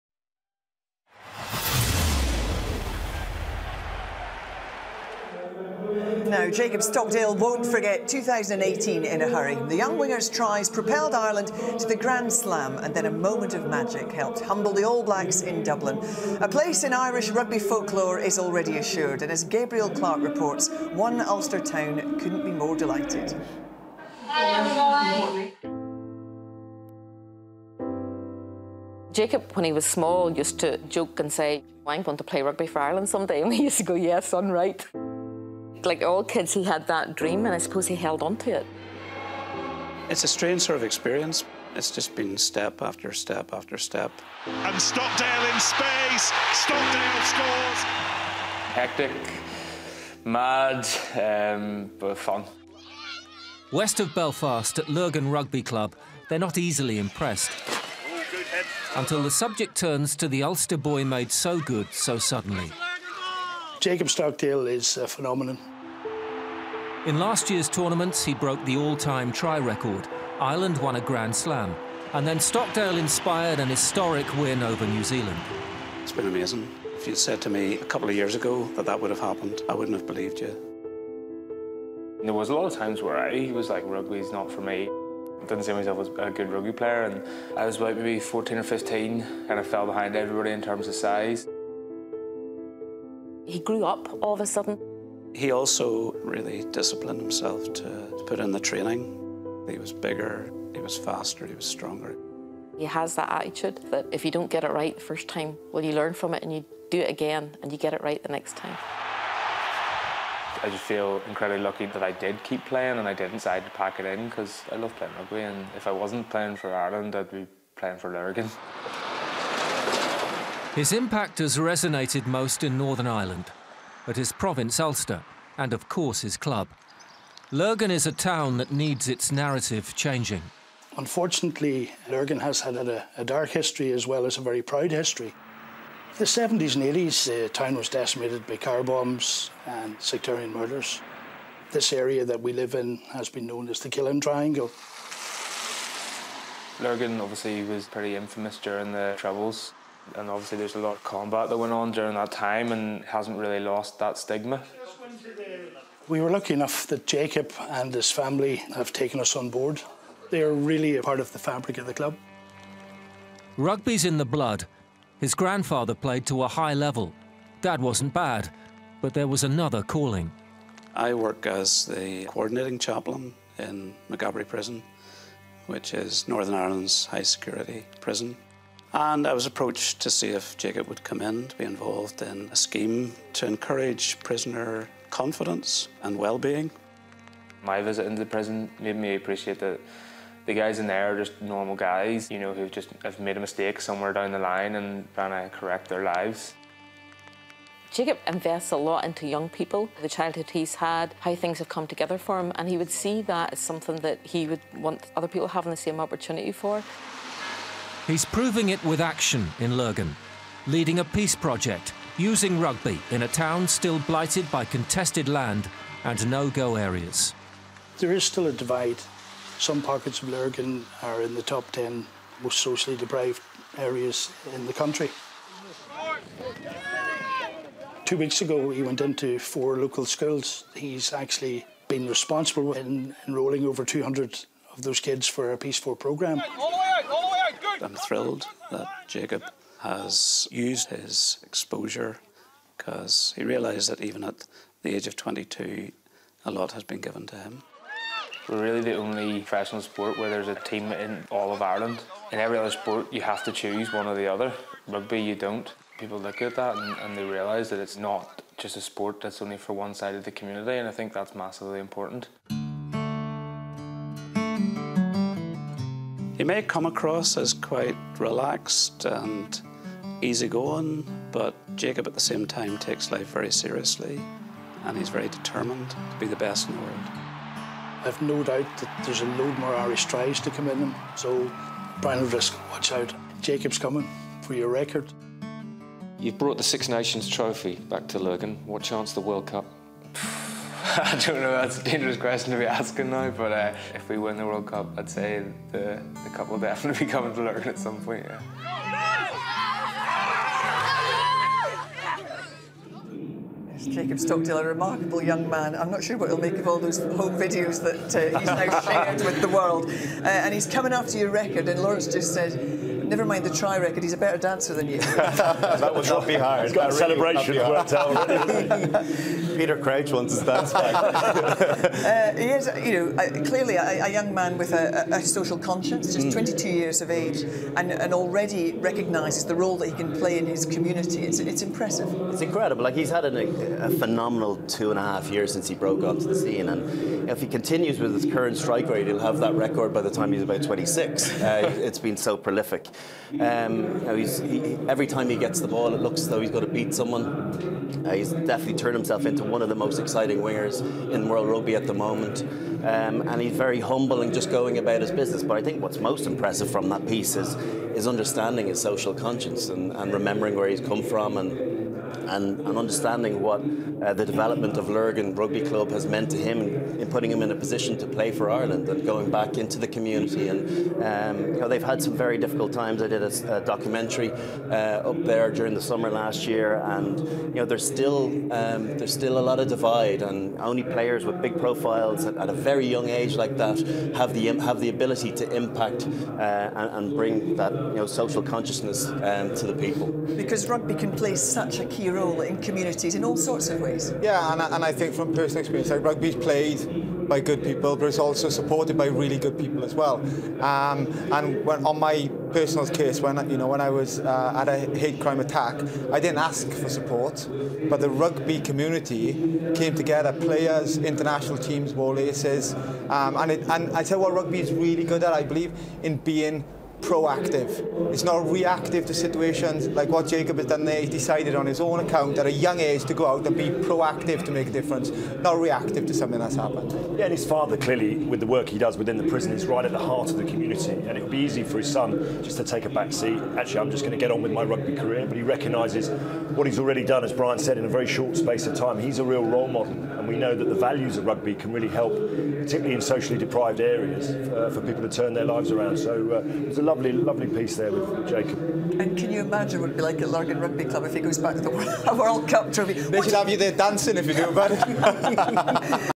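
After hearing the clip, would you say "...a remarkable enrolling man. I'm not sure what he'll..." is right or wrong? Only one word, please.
wrong.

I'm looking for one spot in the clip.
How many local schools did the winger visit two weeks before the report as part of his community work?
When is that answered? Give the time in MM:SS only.
03:49.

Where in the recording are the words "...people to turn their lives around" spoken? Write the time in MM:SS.
07:24.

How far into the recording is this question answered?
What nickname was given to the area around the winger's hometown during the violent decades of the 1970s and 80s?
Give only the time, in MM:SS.
02:23.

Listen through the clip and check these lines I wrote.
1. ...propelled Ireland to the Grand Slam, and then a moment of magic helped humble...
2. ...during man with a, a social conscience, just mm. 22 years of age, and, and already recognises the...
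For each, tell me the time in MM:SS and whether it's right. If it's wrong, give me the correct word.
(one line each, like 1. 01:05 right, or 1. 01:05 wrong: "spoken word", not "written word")
1. 00:10 right
2. 05:24 wrong: "young", not "during".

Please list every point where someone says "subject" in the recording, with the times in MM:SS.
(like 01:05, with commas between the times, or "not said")
00:59.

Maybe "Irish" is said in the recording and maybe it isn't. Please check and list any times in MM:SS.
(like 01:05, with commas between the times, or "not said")
00:16, 04:39.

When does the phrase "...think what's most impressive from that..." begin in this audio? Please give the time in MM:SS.
05:55.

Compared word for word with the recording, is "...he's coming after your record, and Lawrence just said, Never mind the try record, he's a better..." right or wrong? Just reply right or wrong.
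right.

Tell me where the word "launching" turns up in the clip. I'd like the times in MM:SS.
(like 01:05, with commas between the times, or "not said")
not said.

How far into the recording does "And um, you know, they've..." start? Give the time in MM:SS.
06:10.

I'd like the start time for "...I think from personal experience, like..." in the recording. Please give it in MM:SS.
06:34.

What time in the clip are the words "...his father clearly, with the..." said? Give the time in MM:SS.
07:07.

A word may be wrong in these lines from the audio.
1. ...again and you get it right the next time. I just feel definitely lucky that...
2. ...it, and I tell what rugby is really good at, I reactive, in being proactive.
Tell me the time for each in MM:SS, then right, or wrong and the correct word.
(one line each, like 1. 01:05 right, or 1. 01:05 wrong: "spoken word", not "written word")
1. 01:47 wrong: "incredibly", not "definitely"
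2. 06:53 wrong: "believe", not "reactive".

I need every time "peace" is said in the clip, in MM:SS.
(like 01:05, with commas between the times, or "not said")
03:31, 03:55.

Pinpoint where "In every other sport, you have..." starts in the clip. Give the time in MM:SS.
04:12.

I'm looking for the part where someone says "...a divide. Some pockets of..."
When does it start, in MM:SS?
03:38.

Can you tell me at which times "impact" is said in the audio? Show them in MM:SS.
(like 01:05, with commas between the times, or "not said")
02:00, 06:25.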